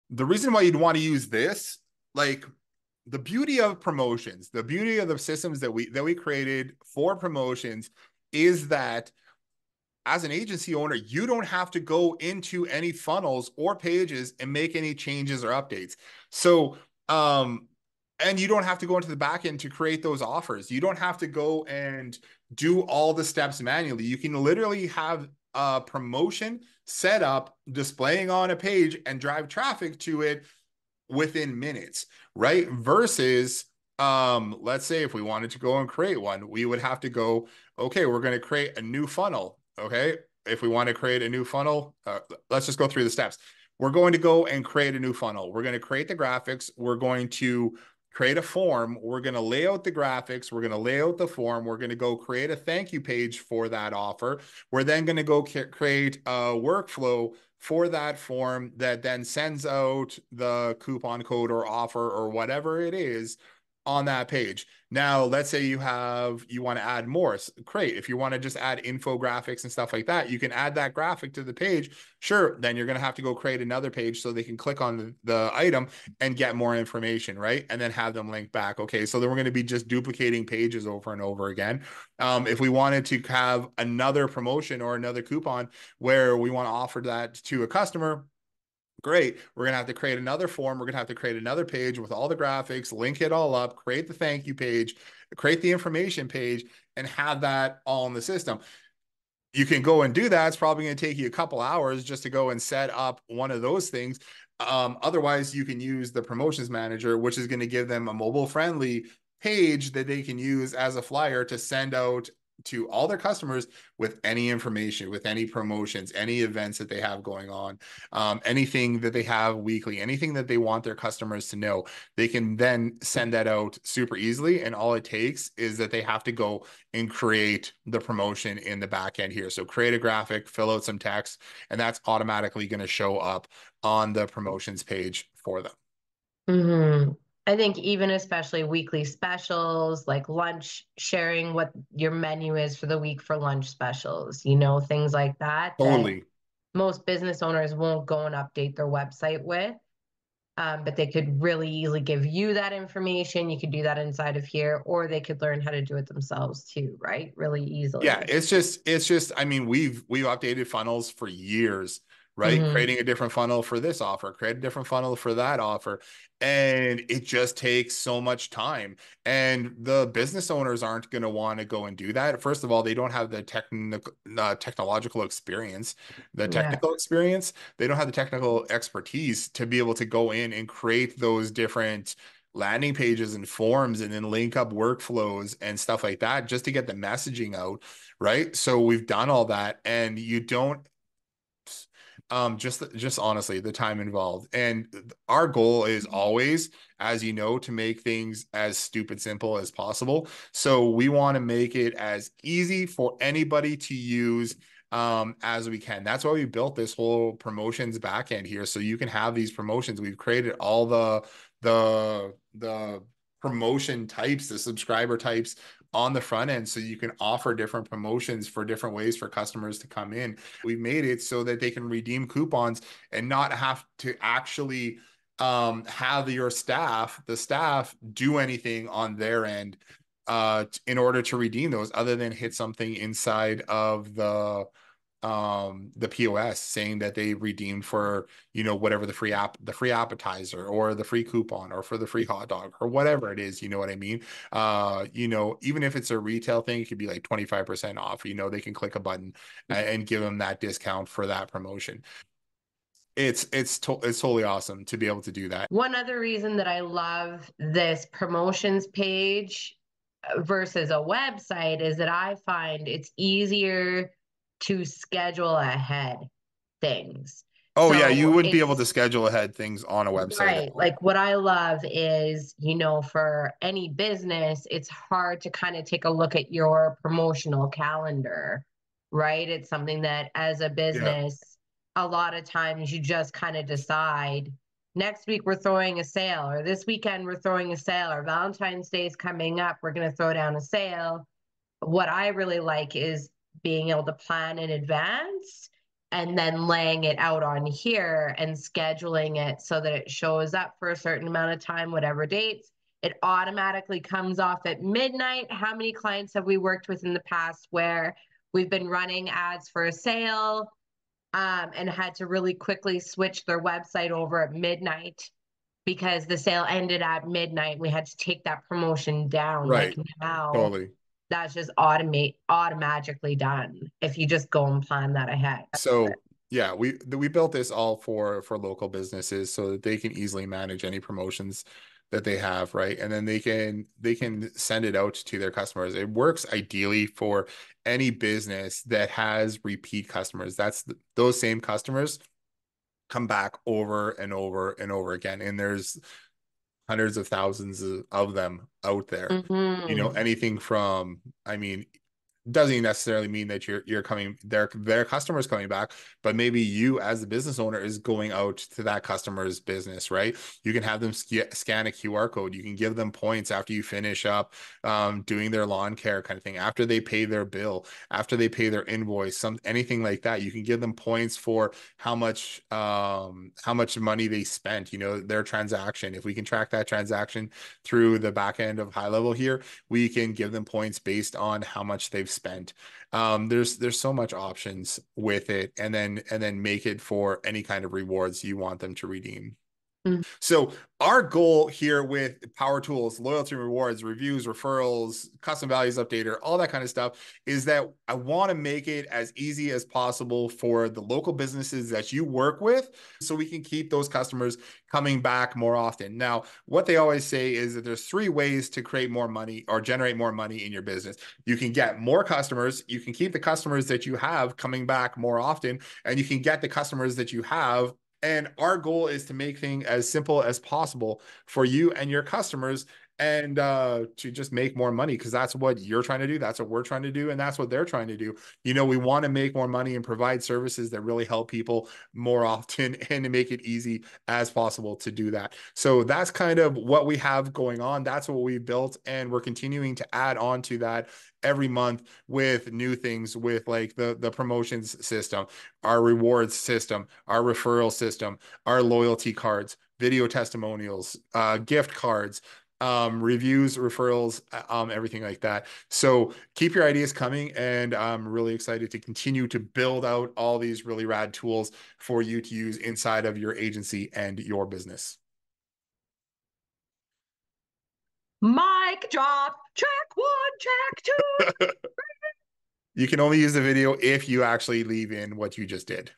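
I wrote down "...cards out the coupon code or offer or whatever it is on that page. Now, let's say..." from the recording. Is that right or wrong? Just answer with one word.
wrong.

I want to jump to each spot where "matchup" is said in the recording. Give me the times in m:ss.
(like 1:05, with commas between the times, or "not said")
not said.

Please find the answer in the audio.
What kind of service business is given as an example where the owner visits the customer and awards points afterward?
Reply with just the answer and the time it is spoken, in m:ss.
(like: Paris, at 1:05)
lawn care, at 6:05.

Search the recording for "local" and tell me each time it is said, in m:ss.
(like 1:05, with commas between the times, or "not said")
5:28, 6:41.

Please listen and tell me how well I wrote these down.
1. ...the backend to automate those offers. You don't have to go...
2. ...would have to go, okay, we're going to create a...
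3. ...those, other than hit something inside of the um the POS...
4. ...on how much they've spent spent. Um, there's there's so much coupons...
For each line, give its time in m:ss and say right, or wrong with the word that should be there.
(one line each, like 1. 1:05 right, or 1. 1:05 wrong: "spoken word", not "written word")
1. 0:19 wrong: "create", not "automate"
2. 0:36 right
3. 3:51 right
4. 6:21 wrong: "options", not "coupons".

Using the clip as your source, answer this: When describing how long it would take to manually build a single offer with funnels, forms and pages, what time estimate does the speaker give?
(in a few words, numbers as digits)
a couple hours.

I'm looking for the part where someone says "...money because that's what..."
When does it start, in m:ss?
7:04.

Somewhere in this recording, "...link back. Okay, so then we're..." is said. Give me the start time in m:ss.
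1:18.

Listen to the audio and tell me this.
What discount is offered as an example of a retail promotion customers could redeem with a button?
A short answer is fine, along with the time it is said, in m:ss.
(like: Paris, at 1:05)
25% off, at 4:07.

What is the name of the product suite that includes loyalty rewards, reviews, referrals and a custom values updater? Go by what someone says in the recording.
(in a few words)
Power Tools.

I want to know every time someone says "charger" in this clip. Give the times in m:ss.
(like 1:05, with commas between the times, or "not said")
not said.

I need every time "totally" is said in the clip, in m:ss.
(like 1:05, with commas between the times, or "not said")
4:14, 5:20.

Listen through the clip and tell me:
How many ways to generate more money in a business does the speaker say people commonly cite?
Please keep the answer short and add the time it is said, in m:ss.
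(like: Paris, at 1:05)
3, at 6:48.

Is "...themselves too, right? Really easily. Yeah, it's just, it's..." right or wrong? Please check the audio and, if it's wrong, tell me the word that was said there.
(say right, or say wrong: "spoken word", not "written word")
right.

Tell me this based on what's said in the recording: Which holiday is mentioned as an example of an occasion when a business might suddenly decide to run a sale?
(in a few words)
Valentine's Day.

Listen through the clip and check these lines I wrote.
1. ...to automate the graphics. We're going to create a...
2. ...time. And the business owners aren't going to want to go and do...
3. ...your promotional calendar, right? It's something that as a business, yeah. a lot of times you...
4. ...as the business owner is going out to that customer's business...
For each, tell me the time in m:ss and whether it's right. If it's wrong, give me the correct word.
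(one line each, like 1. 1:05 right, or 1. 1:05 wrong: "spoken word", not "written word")
1. 0:45 wrong: "create", not "automate"
2. 2:48 right
3. 4:36 right
4. 5:56 right.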